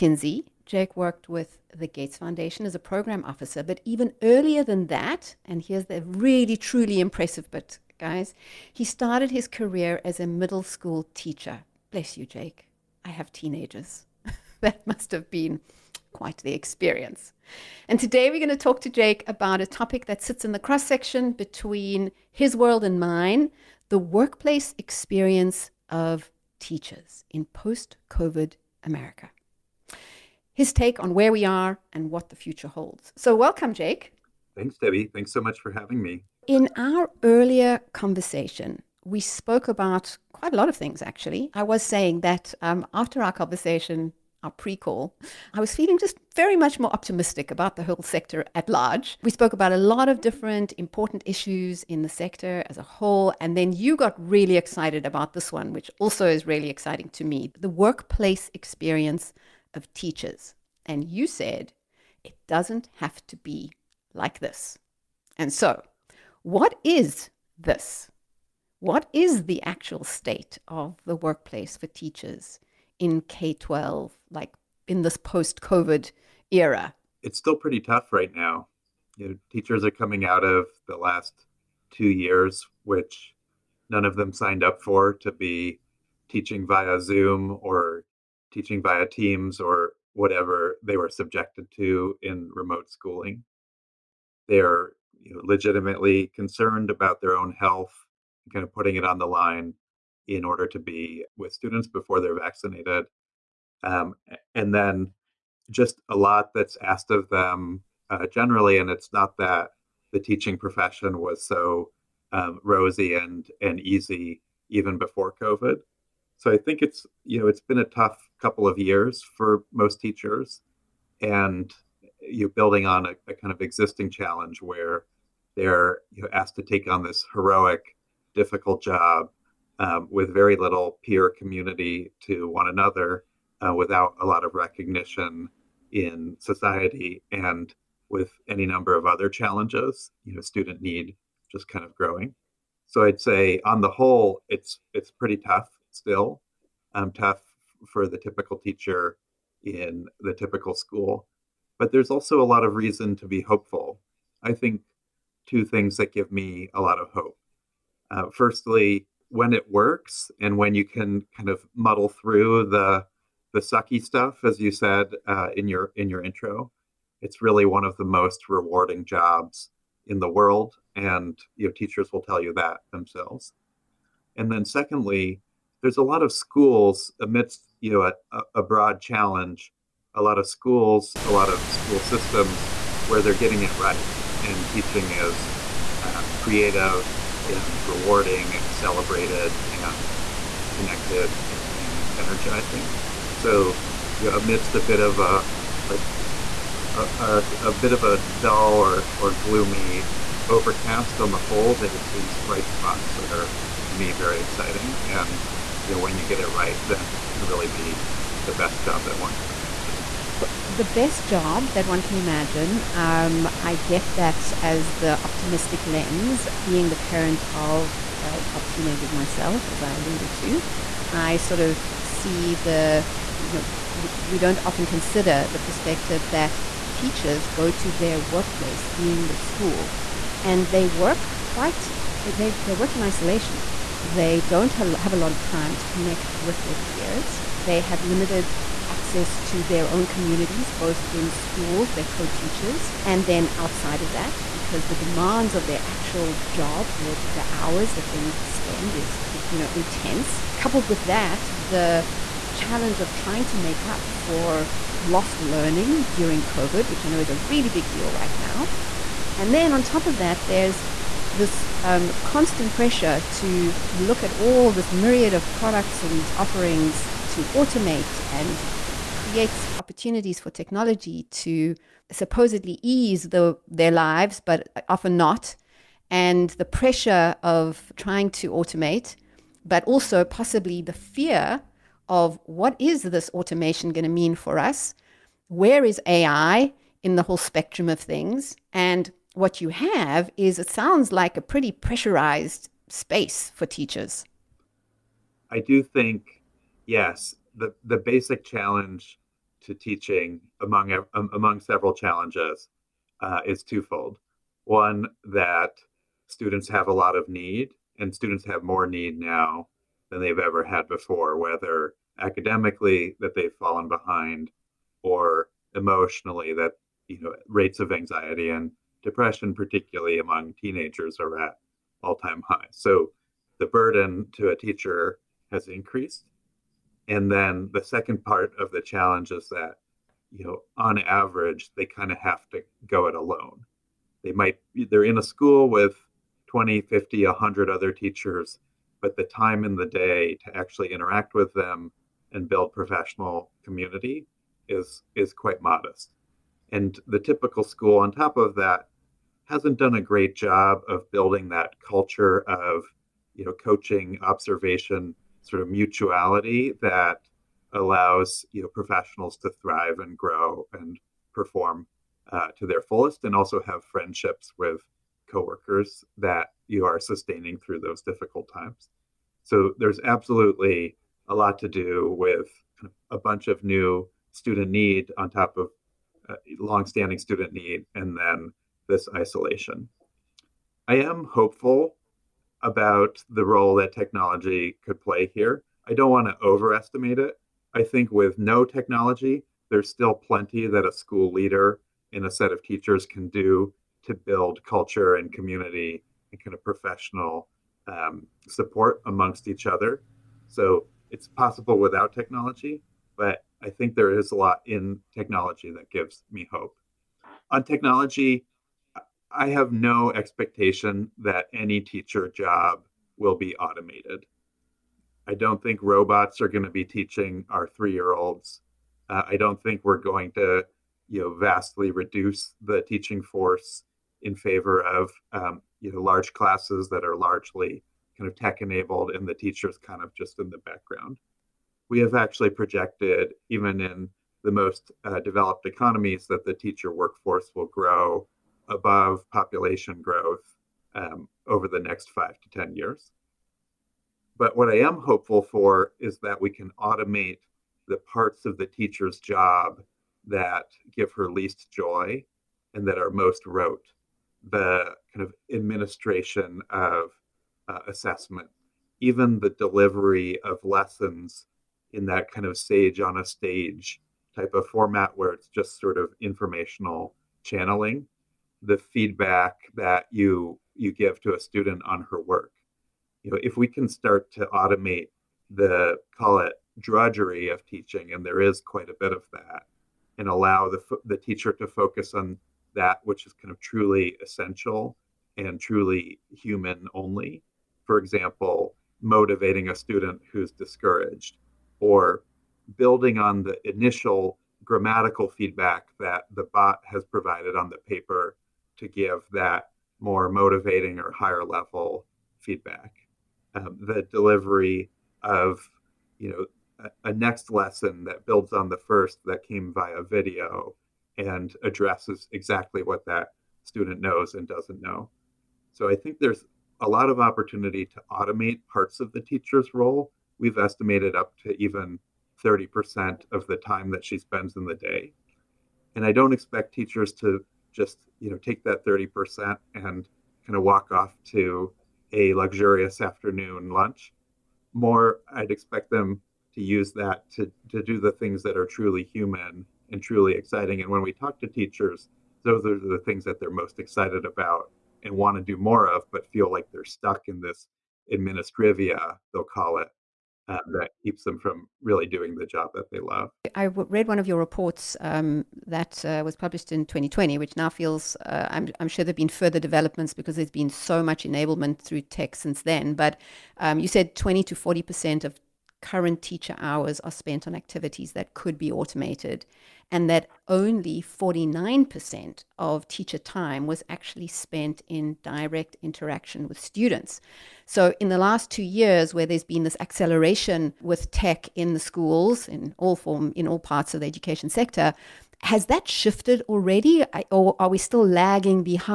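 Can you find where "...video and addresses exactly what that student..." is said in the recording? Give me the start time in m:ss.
8:30.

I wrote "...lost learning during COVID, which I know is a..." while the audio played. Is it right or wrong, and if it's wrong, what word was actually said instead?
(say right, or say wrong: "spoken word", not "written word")
right.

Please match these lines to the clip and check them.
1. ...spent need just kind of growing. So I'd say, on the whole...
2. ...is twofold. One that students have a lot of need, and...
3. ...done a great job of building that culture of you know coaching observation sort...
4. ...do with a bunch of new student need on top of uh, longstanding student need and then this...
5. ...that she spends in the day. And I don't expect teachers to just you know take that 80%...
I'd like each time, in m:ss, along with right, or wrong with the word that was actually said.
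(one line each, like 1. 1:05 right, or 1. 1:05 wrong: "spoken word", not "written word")
1. 2:20 wrong: "student", not "spent"
2. 5:03 right
3. 5:49 right
4. 6:11 right
5. 8:43 wrong: "30", not "80".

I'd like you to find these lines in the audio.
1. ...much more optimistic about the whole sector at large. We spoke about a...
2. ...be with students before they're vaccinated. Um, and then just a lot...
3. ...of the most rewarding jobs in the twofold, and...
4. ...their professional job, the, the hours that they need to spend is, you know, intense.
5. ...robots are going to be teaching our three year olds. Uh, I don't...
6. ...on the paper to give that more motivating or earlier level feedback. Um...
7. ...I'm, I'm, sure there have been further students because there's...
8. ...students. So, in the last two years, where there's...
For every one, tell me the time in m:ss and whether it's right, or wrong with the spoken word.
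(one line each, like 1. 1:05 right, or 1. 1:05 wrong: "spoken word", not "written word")
1. 0:46 right
2. 1:40 right
3. 2:47 wrong: "world", not "twofold"
4. 4:05 wrong: "actual", not "professional"
5. 6:55 right
6. 8:17 wrong: "higher", not "earlier"
7. 9:18 wrong: "developments", not "students"
8. 9:36 right.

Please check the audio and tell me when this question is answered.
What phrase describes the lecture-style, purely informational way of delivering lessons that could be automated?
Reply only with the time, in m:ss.
7:42.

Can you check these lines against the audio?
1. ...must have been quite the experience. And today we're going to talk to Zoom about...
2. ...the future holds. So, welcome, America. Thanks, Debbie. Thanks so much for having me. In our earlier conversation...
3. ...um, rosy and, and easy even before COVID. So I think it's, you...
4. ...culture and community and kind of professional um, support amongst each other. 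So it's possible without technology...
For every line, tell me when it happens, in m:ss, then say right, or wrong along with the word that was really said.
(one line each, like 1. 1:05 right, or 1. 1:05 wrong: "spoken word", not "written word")
1. 0:14 wrong: "Jake", not "Zoom"
2. 0:32 wrong: "Jake", not "America"
3. 1:52 right
4. 6:34 right.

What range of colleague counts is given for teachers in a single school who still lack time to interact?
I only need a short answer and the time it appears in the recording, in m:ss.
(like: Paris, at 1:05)
20 to 100, at 5:36.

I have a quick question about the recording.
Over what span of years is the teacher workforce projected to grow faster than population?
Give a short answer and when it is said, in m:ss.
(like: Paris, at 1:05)
5 to 10 years, at 7:22.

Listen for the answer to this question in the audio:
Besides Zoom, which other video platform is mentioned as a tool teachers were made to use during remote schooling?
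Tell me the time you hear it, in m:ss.
1:29.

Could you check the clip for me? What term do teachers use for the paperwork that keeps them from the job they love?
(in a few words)
Administrivia.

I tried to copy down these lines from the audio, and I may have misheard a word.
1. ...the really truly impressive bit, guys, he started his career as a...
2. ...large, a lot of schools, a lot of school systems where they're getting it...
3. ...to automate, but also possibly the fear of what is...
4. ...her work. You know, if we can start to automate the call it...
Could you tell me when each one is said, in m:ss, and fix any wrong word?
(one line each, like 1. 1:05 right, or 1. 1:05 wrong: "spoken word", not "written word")
1. 0:05 right
2. 2:59 wrong: "challenge", not "large"
3. 4:38 right
4. 7:52 right.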